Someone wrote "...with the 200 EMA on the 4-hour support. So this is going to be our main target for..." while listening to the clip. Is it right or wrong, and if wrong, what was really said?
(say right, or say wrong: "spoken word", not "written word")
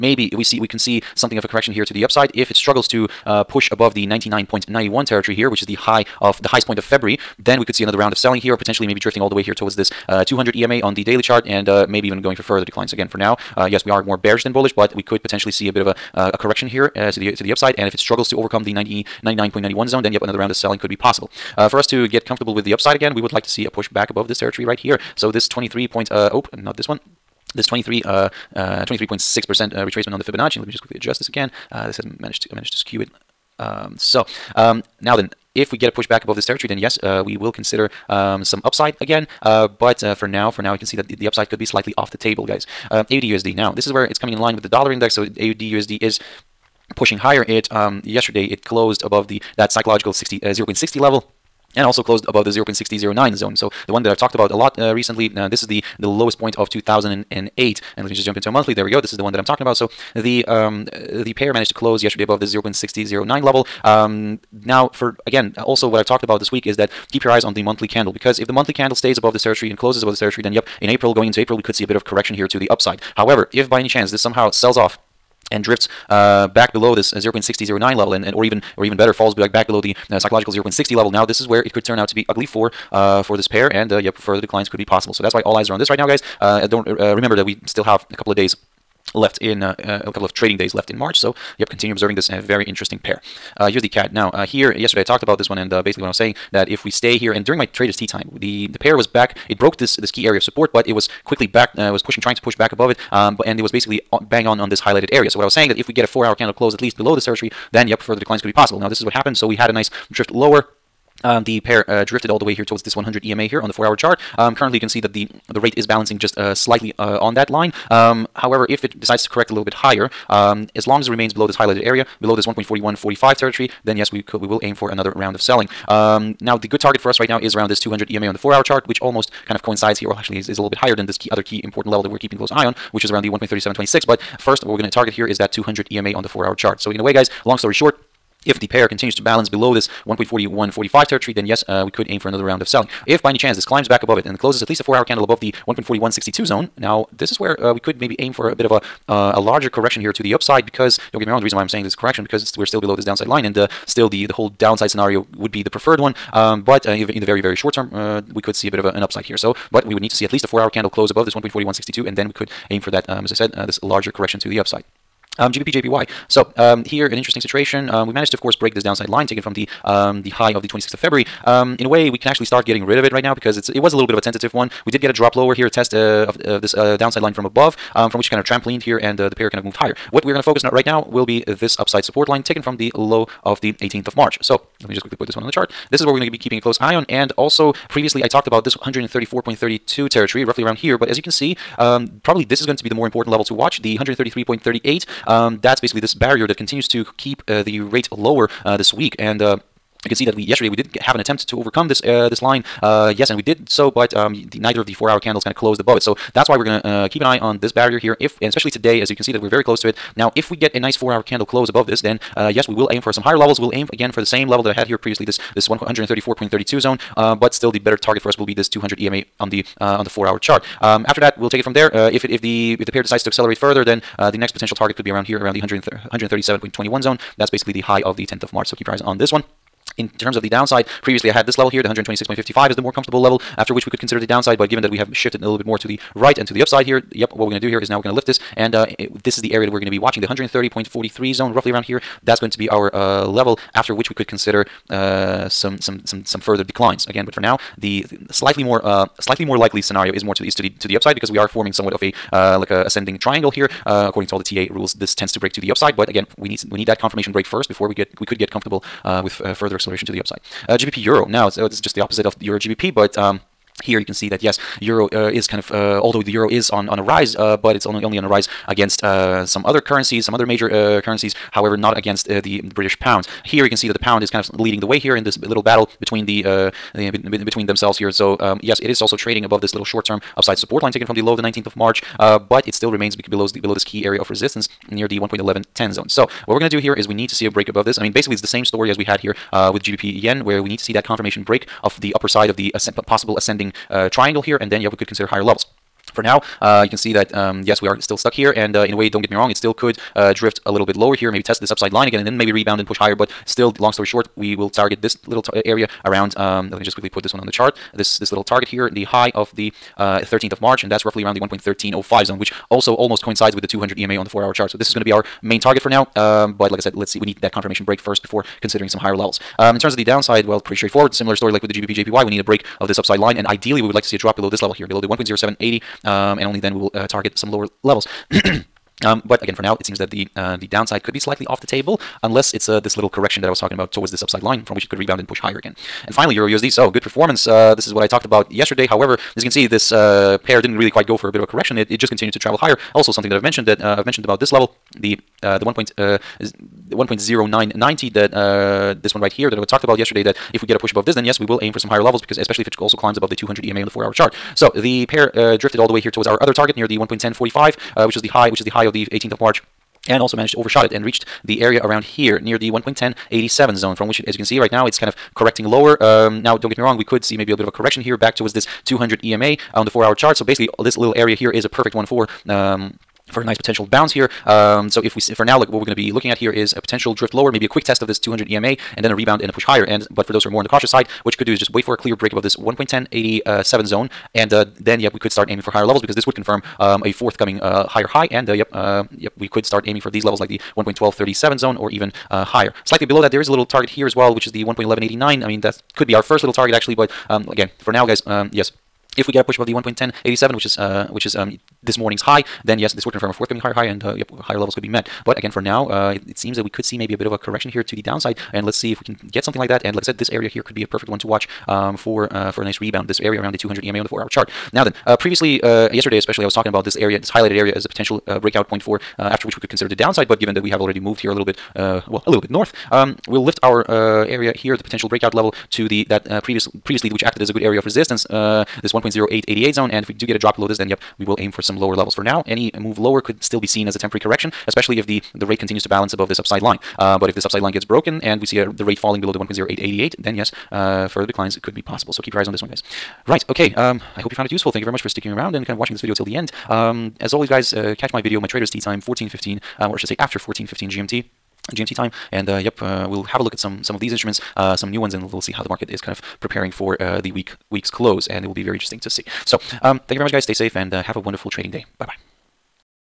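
wrong: "chart", not "support".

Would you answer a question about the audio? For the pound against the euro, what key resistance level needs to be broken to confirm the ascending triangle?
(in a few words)
1.1110.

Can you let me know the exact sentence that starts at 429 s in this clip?
And if we do get a drop below this, then yep, we will aim for some lower levels.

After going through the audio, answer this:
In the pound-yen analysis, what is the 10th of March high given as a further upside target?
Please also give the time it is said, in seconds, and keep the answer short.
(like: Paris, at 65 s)
137.21, at 225 s.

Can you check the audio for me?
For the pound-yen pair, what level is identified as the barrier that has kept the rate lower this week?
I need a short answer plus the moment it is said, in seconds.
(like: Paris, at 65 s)
133.38, at 193 s.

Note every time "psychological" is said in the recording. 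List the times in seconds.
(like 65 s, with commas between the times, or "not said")
49 s, 80 s.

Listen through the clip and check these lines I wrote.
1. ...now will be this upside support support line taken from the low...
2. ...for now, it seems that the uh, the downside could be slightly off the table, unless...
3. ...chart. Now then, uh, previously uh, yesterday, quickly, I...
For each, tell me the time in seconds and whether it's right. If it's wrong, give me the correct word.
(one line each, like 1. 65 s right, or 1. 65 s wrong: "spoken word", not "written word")
1. 180 s right
2. 329 s right
3. 414 s wrong: "especially", not "quickly".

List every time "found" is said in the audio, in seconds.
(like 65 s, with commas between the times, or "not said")
444 s.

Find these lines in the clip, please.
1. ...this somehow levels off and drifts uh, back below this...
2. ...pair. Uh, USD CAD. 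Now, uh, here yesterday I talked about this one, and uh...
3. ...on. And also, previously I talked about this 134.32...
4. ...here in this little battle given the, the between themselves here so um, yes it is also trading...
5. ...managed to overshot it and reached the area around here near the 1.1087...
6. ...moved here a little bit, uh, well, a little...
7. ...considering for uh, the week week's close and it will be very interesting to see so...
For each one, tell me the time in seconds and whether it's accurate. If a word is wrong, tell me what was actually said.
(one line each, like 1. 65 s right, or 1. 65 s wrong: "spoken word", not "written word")
1. 74 s wrong: "sells", not "levels"
2. 92 s right
3. 186 s right
4. 274 s wrong: "between", not "given"
5. 360 s right
6. 420 s right
7. 456 s wrong: "preparing", not "considering".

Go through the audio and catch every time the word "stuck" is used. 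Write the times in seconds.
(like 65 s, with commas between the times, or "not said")
298 s.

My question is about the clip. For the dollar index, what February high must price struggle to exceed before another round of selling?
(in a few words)
99.91.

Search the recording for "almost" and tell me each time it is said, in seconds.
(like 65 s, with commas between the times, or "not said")
129 s, 312 s.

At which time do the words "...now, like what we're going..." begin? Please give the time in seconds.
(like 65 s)
375 s.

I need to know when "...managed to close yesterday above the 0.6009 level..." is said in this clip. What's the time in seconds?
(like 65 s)
61 s.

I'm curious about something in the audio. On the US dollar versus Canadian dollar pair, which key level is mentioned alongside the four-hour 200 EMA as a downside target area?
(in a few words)
1.3726.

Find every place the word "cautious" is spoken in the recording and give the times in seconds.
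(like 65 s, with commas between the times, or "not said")
380 s.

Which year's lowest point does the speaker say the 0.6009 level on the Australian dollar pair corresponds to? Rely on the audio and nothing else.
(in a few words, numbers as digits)
2008.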